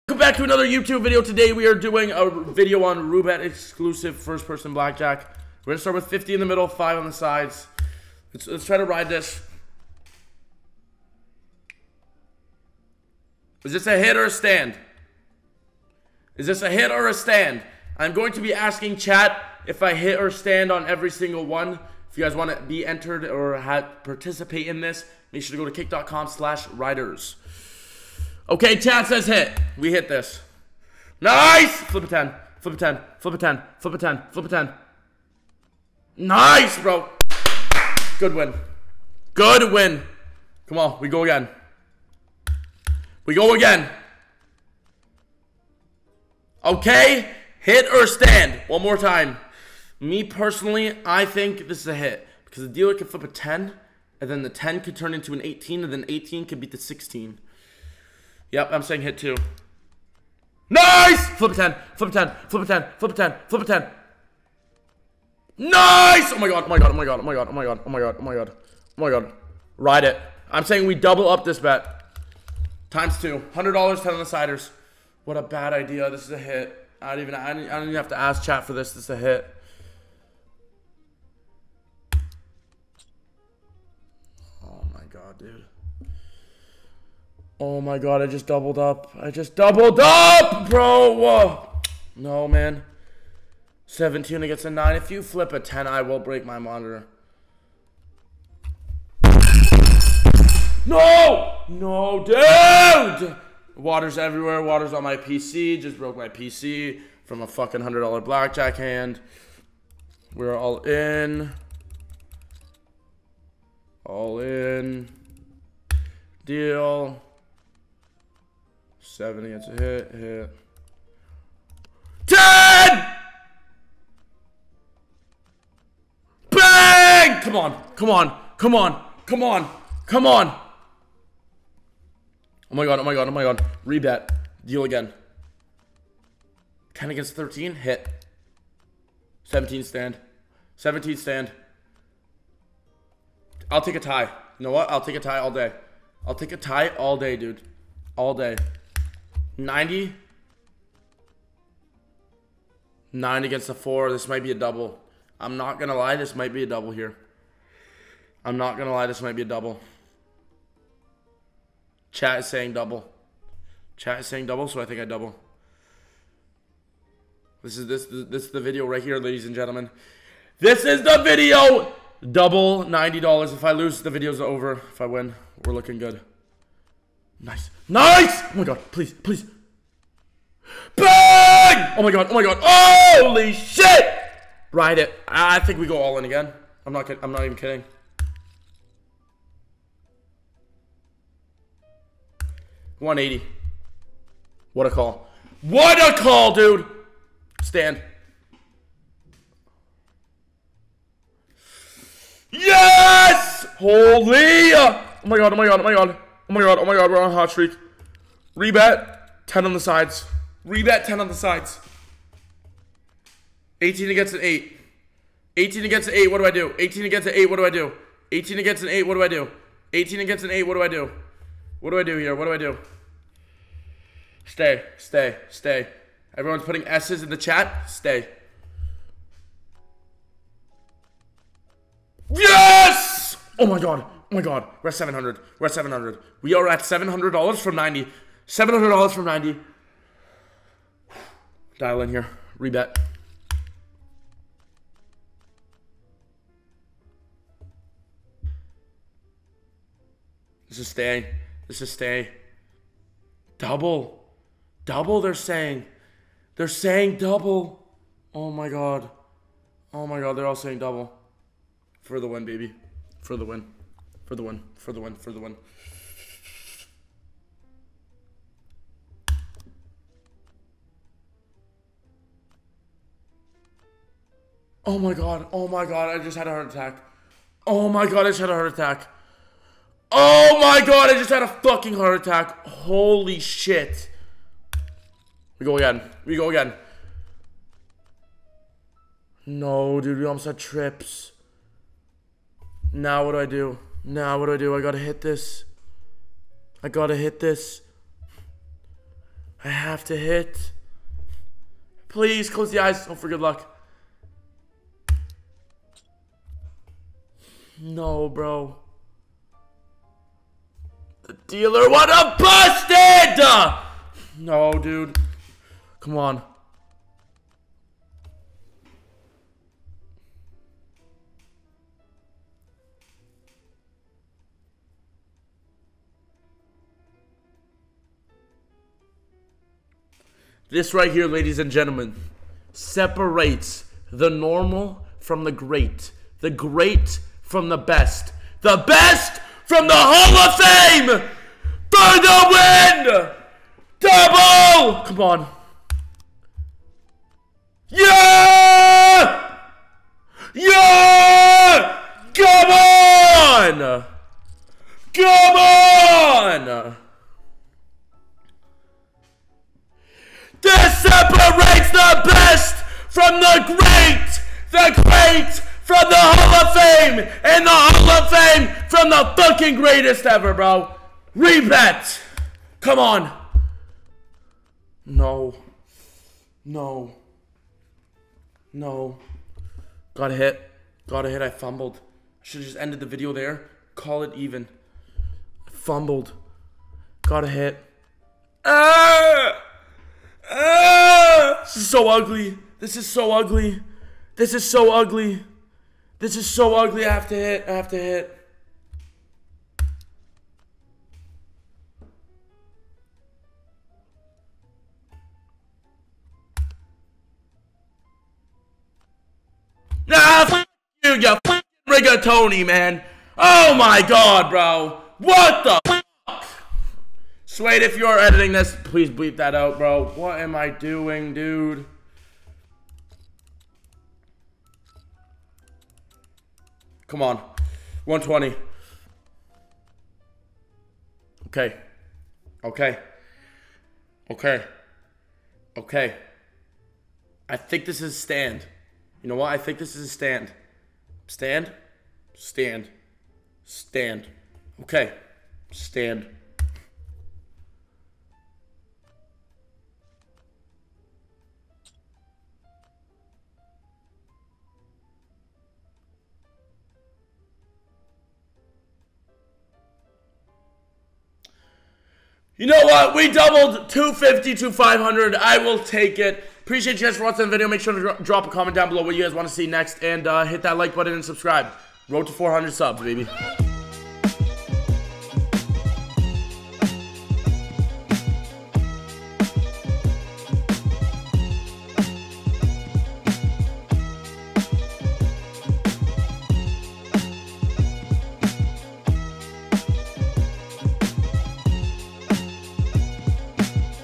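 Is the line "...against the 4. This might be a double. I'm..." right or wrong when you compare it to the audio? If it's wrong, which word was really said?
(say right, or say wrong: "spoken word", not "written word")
right.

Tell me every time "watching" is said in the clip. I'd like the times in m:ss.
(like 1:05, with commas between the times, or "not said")
7:47.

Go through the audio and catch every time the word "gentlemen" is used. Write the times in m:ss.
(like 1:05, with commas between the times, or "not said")
2:49, 5:31.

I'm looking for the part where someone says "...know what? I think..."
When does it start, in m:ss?
7:19.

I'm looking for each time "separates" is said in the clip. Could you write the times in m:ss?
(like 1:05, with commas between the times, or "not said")
5:32, 6:01.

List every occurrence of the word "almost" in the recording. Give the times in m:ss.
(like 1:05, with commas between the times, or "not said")
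4:50.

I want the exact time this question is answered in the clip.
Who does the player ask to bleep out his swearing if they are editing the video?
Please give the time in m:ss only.
6:57.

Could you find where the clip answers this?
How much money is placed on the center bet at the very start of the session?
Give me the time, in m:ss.
0:06.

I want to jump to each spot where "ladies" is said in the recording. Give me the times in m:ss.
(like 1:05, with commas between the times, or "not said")
2:49, 5:31.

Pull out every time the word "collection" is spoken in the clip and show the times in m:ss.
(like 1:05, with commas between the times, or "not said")
not said.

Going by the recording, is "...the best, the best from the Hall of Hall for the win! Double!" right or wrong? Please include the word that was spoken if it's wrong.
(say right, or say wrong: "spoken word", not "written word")
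wrong: "Fame", not "Hall".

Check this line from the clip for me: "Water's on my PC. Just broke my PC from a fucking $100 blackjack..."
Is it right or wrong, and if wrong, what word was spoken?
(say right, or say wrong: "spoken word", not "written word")
right.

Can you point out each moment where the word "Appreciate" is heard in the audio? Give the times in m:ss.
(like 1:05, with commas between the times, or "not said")
7:46.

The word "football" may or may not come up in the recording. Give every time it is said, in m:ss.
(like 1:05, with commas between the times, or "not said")
not said.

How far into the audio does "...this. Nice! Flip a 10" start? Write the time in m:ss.
0:30.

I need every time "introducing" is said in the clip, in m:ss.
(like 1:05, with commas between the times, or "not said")
not said.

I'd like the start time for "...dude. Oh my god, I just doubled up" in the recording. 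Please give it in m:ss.
1:25.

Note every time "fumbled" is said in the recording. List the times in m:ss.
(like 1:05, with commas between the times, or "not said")
6:21, 6:25.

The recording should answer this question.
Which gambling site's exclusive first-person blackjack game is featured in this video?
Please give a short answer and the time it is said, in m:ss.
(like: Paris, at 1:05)
Roobet, at 0:03.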